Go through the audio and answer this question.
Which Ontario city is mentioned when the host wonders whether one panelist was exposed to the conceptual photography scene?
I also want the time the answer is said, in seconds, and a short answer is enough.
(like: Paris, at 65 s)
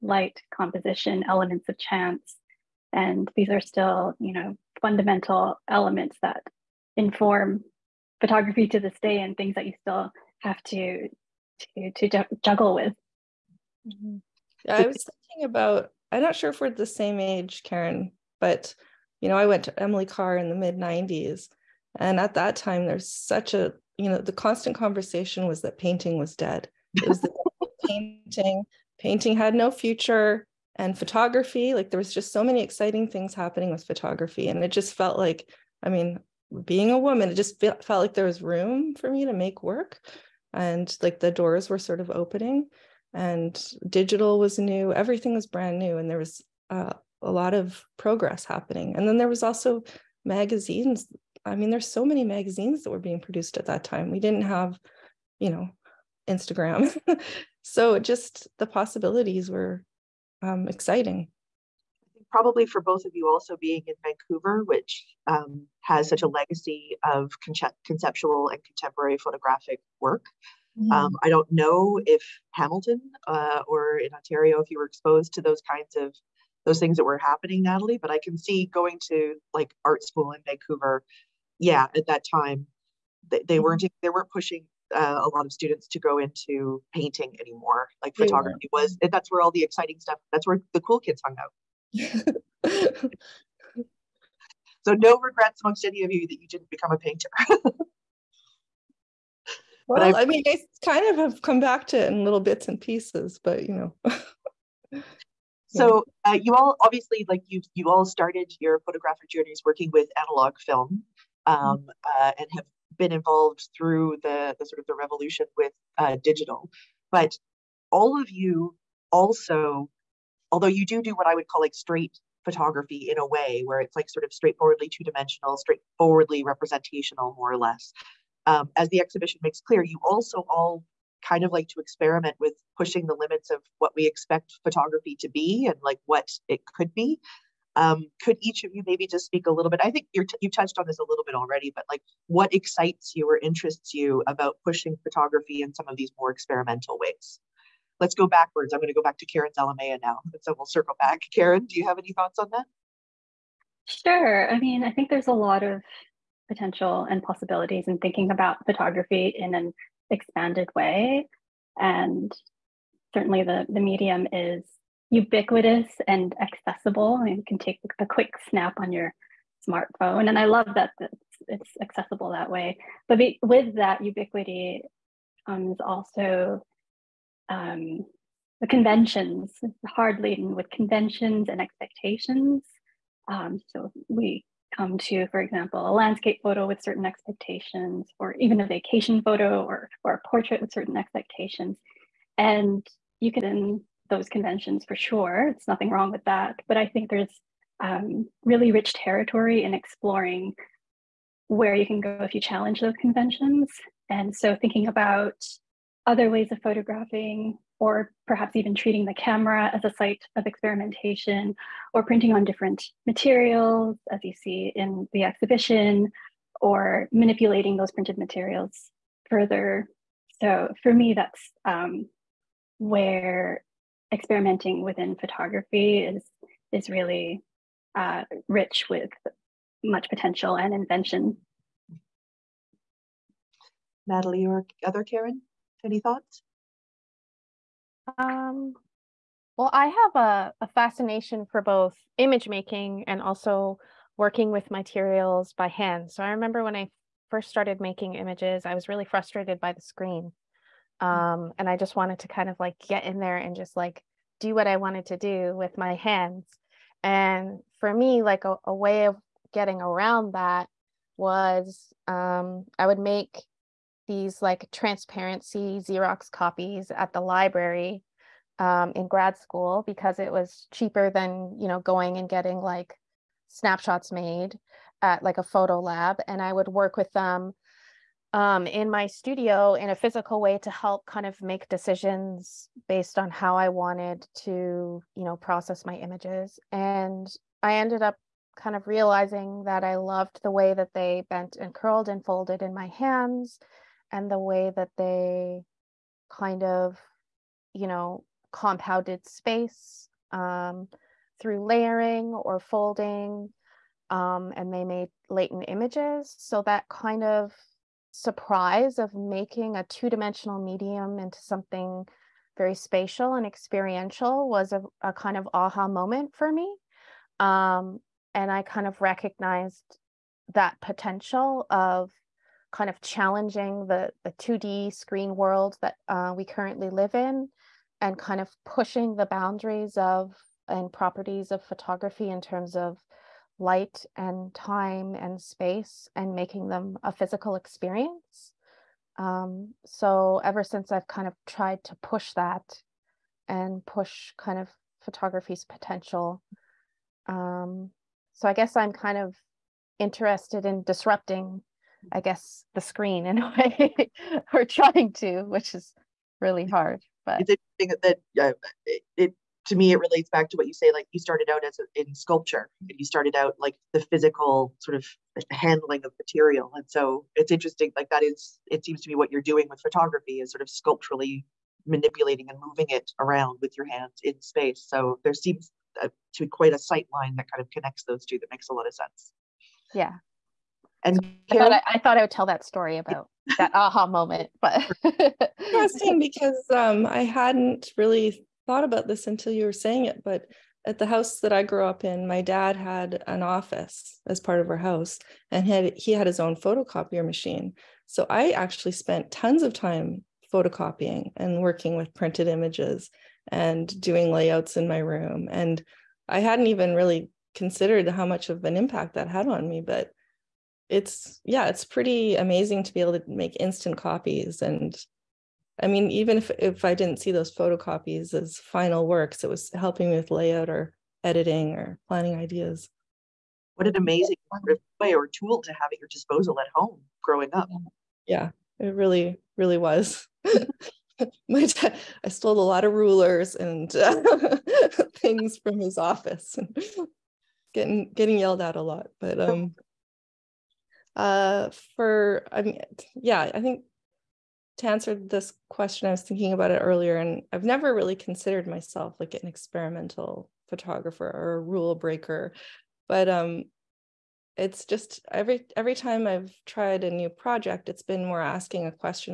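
Hamilton, at 72 s.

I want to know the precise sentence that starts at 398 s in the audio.
So I actually spent tons of time photocopying and working with printed images and doing layouts in my room.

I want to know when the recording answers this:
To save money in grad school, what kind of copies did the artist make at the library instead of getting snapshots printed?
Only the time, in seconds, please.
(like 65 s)
264 s.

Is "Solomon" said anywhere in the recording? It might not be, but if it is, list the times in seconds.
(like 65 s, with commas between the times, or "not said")
not said.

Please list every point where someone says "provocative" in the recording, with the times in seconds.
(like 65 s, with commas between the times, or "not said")
not said.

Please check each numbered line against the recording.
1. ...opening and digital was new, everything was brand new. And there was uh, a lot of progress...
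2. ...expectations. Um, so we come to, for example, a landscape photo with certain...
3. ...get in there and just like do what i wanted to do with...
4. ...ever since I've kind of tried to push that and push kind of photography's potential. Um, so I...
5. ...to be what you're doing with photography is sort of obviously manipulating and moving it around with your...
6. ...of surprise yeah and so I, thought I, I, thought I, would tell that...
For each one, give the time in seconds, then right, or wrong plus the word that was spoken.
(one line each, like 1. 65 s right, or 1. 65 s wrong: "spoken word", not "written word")
1. 42 s right
2. 181 s right
3. 252 s right
4. 340 s right
5. 369 s wrong: "sculpturally", not "obviously"
6. 378 s wrong: "sense", not "surprise".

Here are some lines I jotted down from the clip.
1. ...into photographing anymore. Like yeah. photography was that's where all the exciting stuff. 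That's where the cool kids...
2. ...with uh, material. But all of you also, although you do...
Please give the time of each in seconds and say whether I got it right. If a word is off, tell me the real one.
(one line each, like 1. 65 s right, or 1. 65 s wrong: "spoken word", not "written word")
1. 86 s wrong: "painting", not "photographing"
2. 115 s wrong: "digital", not "material".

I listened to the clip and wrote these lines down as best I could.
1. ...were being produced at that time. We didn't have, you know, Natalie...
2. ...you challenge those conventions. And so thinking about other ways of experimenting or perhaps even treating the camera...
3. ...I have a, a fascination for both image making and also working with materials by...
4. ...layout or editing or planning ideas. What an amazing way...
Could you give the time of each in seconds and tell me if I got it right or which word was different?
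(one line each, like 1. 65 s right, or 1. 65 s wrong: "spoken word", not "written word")
1. 52 s wrong: "Instagram", not "Natalie"
2. 202 s wrong: "photographing", not "experimenting"
3. 239 s right
4. 420 s right.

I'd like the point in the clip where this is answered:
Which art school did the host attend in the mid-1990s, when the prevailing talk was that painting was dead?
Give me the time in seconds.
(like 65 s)
19 s.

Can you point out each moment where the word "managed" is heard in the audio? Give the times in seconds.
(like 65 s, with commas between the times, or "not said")
not said.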